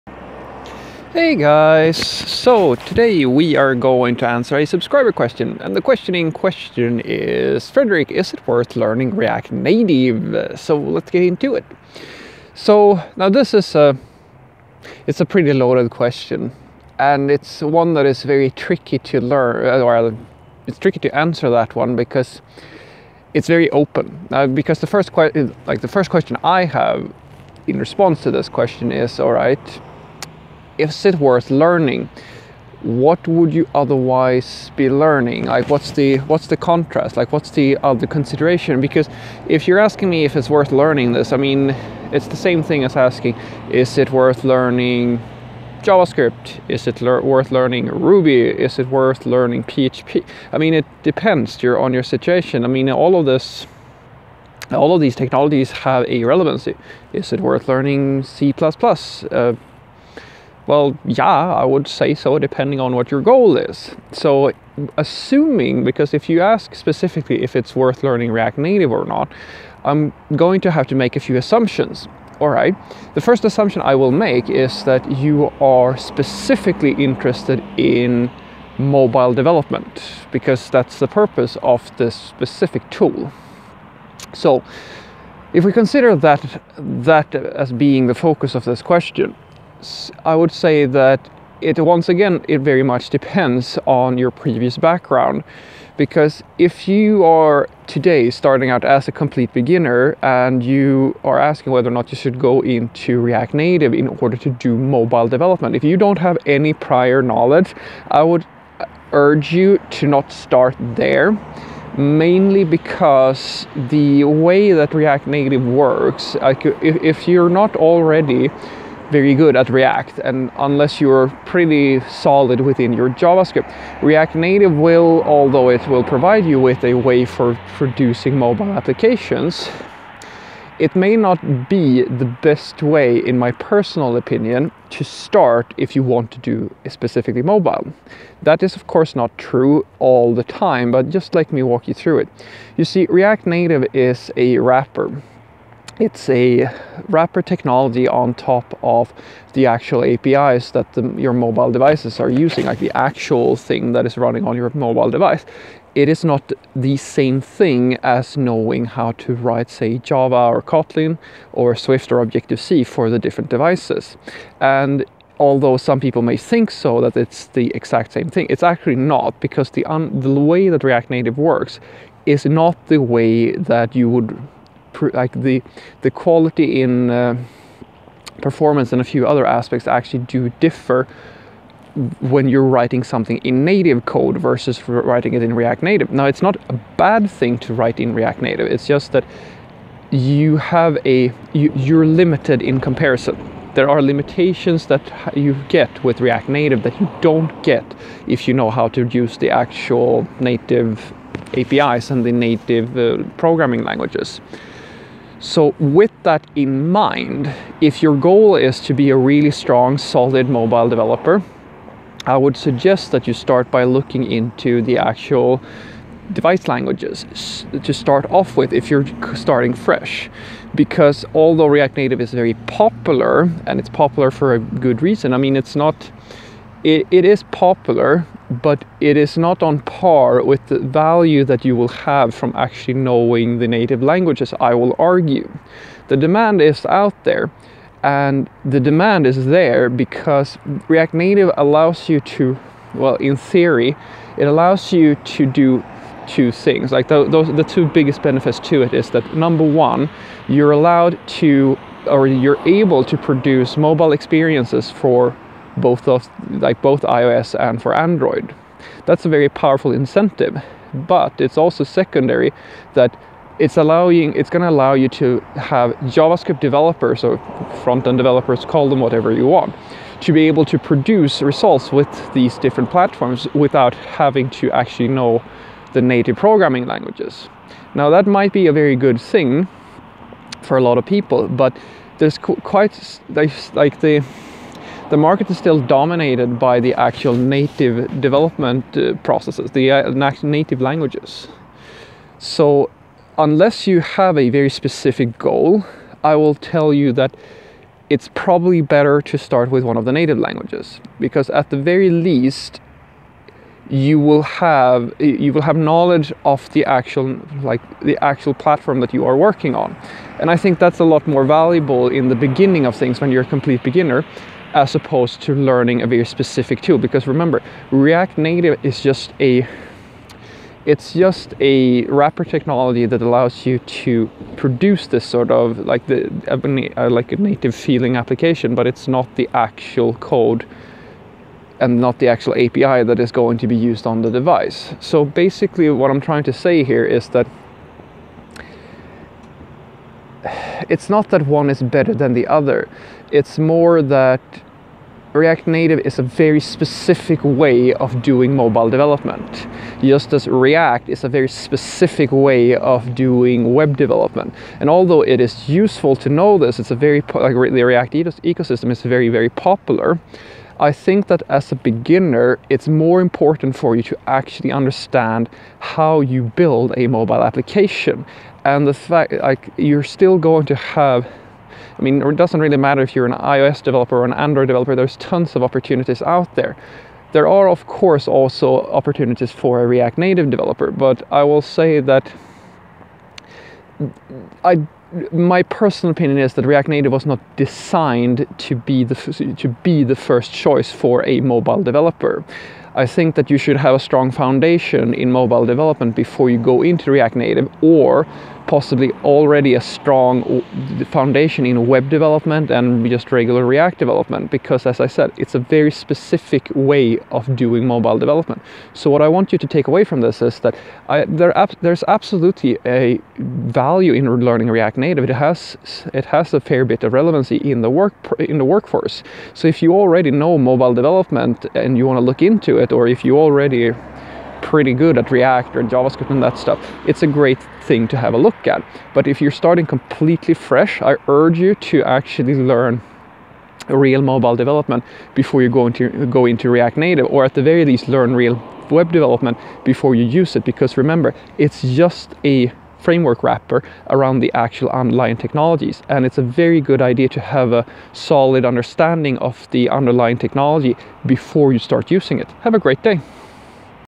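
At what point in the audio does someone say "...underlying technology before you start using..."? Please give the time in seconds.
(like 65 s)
449 s.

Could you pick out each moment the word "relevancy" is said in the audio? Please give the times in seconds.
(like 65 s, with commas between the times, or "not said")
56 s, 417 s.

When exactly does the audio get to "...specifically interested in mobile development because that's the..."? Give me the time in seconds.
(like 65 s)
75 s.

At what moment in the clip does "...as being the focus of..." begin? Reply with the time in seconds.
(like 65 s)
87 s.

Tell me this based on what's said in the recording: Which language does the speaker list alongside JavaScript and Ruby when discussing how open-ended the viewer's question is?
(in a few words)
PHP.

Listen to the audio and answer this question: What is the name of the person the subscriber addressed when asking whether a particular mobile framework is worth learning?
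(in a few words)
Fredrik.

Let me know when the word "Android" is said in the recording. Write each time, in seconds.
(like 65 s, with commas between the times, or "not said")
257 s, 374 s.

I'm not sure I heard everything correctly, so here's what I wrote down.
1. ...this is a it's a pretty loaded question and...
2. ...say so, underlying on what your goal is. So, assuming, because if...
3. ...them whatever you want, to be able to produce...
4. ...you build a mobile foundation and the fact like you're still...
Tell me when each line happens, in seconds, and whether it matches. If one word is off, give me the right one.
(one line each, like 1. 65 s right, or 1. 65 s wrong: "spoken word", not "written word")
1. 13 s right
2. 61 s wrong: "depending", not "underlying"
3. 268 s right
4. 366 s wrong: "application", not "foundation".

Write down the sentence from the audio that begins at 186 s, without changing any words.
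Now, it's not a bad thing to write in React Native.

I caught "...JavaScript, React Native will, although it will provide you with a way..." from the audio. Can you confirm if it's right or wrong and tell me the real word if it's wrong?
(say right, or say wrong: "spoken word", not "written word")
right.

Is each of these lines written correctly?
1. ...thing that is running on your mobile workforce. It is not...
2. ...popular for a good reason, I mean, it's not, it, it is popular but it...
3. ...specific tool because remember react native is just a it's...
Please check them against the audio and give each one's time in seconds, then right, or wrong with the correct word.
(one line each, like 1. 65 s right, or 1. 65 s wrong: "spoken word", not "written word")
1. 153 s wrong: "device", not "workforce"
2. 223 s right
3. 316 s right.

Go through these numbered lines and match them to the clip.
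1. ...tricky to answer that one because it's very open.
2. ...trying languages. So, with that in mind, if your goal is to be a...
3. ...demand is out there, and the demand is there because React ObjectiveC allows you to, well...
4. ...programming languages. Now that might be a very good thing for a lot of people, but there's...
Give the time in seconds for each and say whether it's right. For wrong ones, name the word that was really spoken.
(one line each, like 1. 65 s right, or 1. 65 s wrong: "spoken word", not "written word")
1. 20 s right
2. 203 s wrong: "programming", not "trying"
3. 236 s wrong: "Native", not "ObjectiveC"
4. 276 s right.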